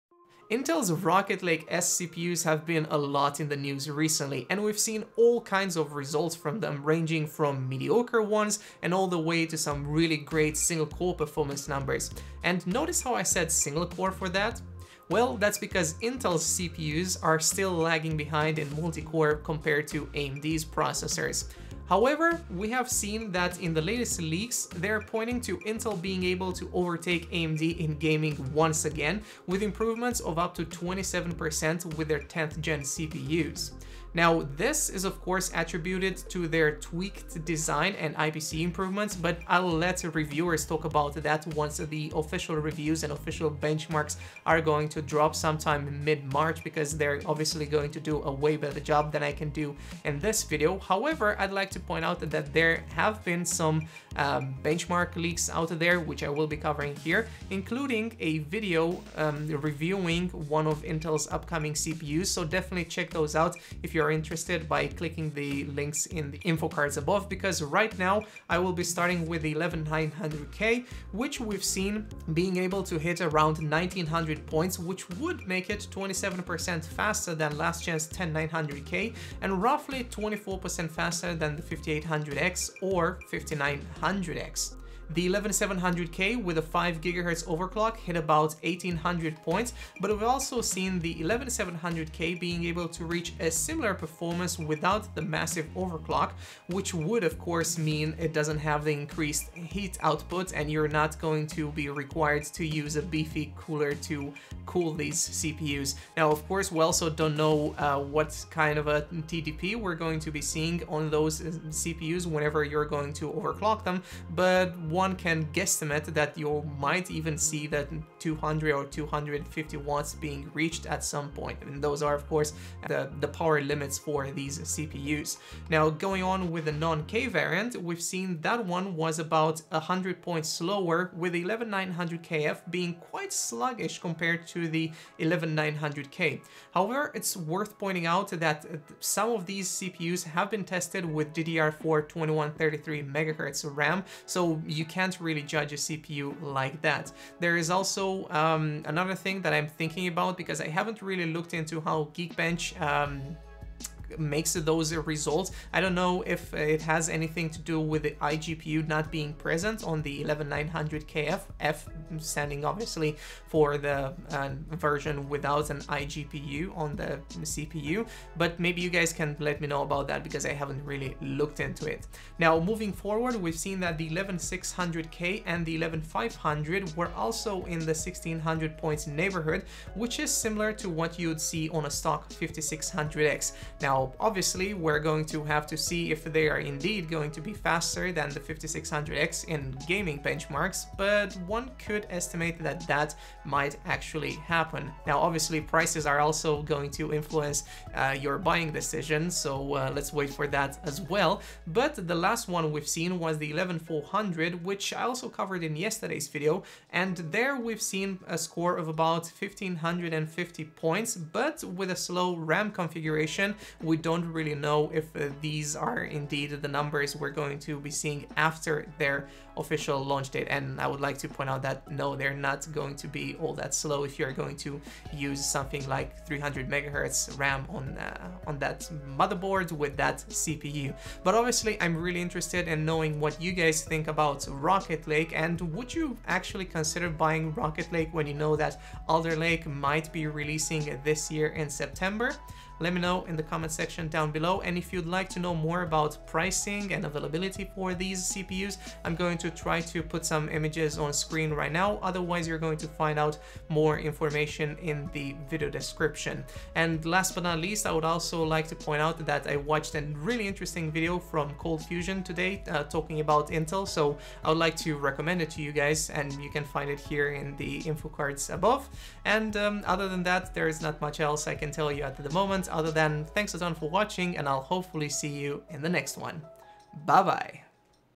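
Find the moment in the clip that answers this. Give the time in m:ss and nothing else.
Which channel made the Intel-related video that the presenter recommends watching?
4:21.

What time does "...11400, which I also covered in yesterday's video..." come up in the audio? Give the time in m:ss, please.
3:23.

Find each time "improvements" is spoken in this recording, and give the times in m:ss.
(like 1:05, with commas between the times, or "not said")
0:29, 0:38.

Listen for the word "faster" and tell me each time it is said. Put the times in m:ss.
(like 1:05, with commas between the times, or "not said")
1:16, 1:20, 3:07.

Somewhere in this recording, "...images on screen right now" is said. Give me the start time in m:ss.
4:10.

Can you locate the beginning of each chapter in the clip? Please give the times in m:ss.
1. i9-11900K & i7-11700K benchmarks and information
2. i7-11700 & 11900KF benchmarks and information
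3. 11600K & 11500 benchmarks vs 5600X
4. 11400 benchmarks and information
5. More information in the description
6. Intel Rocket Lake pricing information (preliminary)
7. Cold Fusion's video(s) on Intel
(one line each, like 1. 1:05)
1. 1:07
2. 2:05
3. 2:50
4. 3:20
5. 3:51
6. 4:05
7. 4:21.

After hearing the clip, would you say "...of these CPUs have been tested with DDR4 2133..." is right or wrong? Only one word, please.
right.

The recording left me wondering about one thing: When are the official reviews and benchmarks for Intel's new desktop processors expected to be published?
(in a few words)
mid-March.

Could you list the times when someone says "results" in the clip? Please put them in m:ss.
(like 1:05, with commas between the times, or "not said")
0:05, 2:34.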